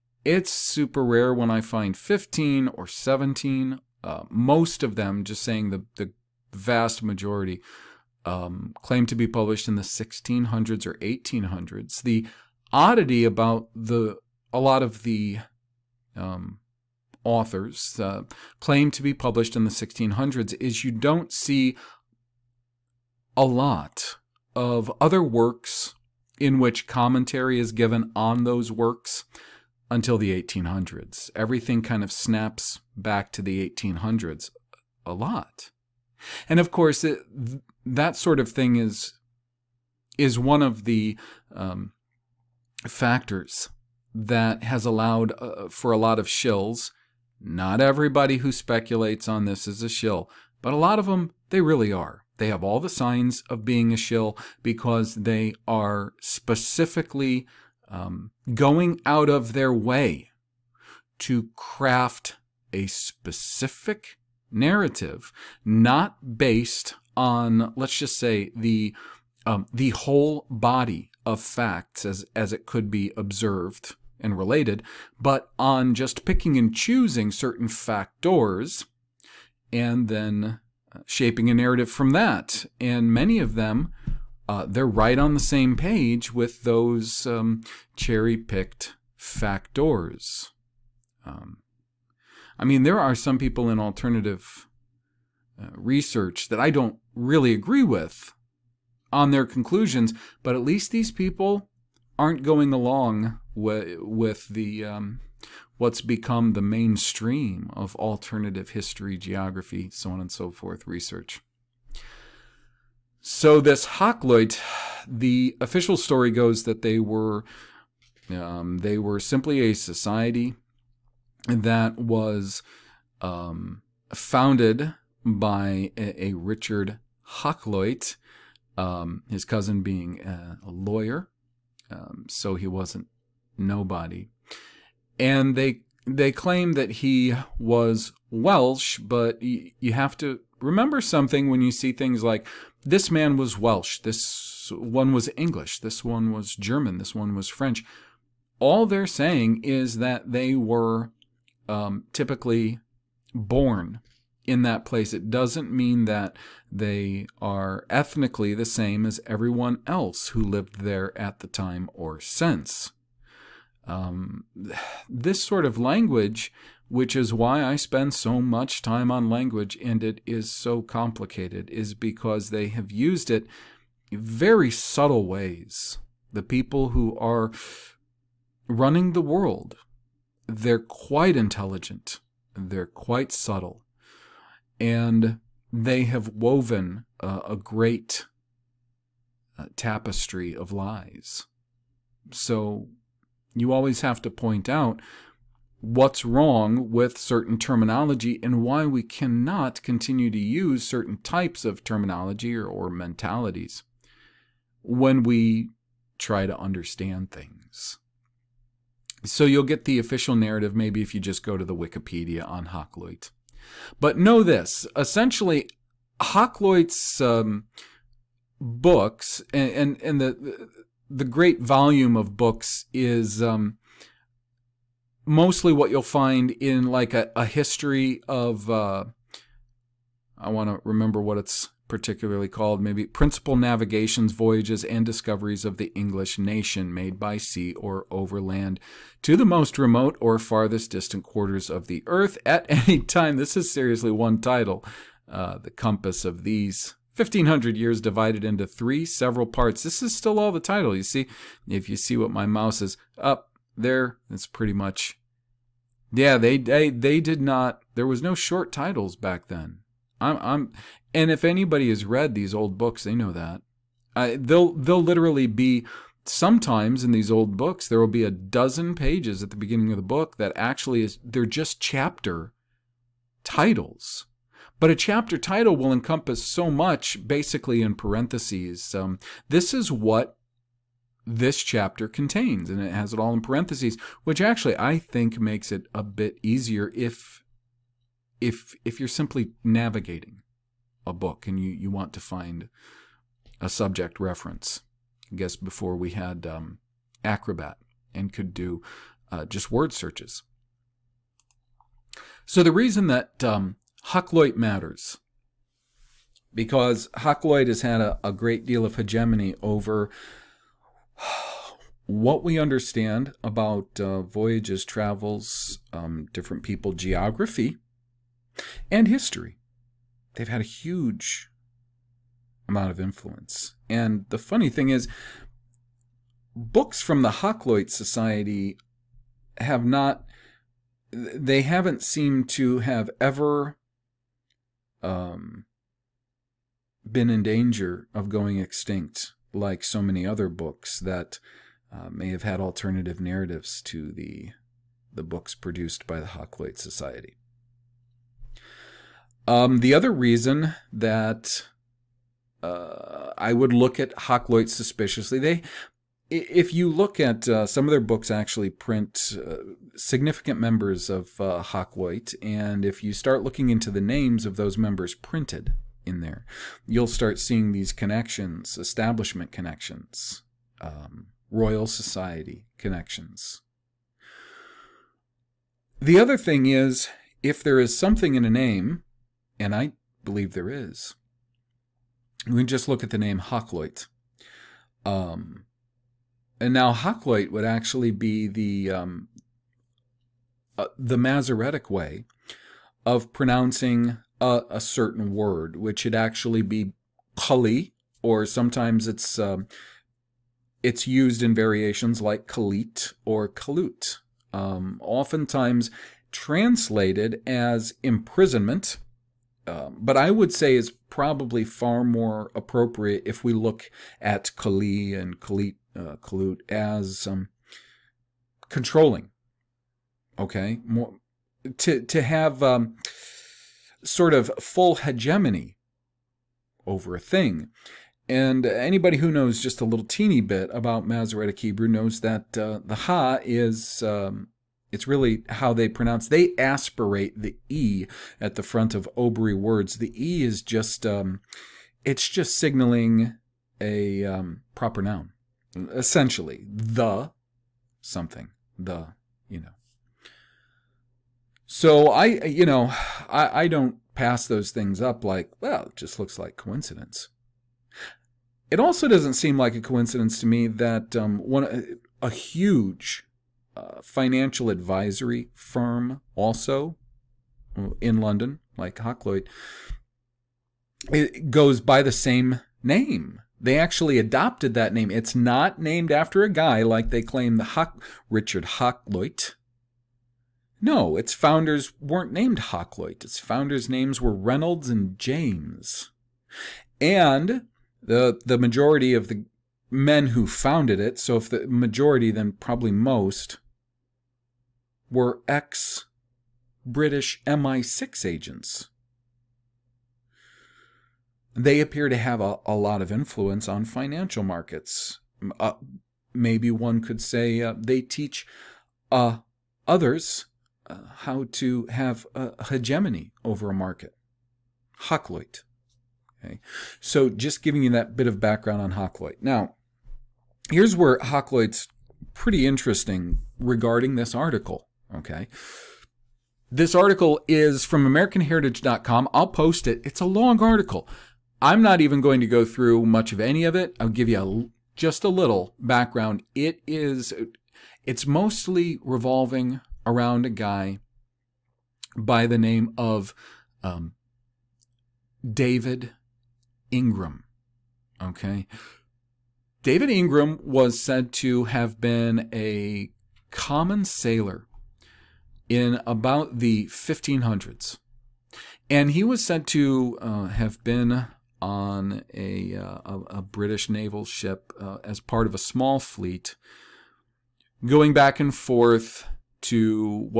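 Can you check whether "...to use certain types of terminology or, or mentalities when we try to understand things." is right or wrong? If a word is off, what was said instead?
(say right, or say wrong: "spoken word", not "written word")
right.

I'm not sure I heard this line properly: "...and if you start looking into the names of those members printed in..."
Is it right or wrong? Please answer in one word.
right.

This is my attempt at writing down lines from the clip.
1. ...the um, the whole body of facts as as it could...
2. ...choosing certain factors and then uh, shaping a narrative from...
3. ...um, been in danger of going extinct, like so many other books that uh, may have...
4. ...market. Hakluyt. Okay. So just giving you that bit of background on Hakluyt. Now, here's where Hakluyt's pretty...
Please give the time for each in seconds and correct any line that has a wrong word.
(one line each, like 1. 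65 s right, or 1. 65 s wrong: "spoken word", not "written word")
1. 68 s right
2. 76 s right
3. 335 s right
4. 513 s right.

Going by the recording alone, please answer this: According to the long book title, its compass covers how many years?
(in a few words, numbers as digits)
1500.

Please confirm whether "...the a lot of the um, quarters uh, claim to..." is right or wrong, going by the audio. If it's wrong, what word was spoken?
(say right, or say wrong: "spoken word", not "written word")
wrong: "authors", not "quarters".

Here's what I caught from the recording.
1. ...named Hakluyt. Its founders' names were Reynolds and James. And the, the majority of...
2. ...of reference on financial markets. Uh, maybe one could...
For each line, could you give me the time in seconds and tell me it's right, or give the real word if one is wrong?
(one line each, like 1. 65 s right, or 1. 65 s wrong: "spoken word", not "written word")
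1. 482 s right
2. 503 s wrong: "influence", not "reference".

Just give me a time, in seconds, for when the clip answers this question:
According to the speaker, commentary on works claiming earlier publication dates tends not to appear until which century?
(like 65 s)
30 s.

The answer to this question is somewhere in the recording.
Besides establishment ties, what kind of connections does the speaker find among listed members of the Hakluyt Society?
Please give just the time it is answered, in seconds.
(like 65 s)
371 s.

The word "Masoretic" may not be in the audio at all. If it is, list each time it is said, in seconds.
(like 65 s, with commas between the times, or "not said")
391 s, 431 s.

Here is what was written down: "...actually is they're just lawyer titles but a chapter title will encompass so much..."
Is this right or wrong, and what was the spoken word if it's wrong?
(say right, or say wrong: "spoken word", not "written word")
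wrong: "chapter", not "lawyer".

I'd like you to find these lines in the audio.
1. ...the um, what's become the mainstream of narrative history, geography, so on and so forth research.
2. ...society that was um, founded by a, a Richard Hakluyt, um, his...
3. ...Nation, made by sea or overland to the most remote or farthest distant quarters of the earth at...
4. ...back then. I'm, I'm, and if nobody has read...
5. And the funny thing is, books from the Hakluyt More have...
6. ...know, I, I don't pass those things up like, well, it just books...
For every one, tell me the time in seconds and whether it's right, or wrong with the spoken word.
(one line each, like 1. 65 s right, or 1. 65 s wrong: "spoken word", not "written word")
1. 104 s wrong: "alternative", not "narrative"
2. 119 s right
3. 236 s right
4. 259 s wrong: "anybody", not "nobody"
5. 323 s wrong: "Society", not "More"
6. 452 s wrong: "looks", not "books".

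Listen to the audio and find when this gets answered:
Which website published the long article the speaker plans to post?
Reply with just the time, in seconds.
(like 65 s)
528 s.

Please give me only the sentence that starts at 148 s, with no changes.
All they're saying is that they were um, typically born in that place.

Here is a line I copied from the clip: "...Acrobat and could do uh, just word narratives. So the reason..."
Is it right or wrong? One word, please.
wrong.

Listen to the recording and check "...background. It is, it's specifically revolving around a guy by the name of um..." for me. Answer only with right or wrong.
wrong.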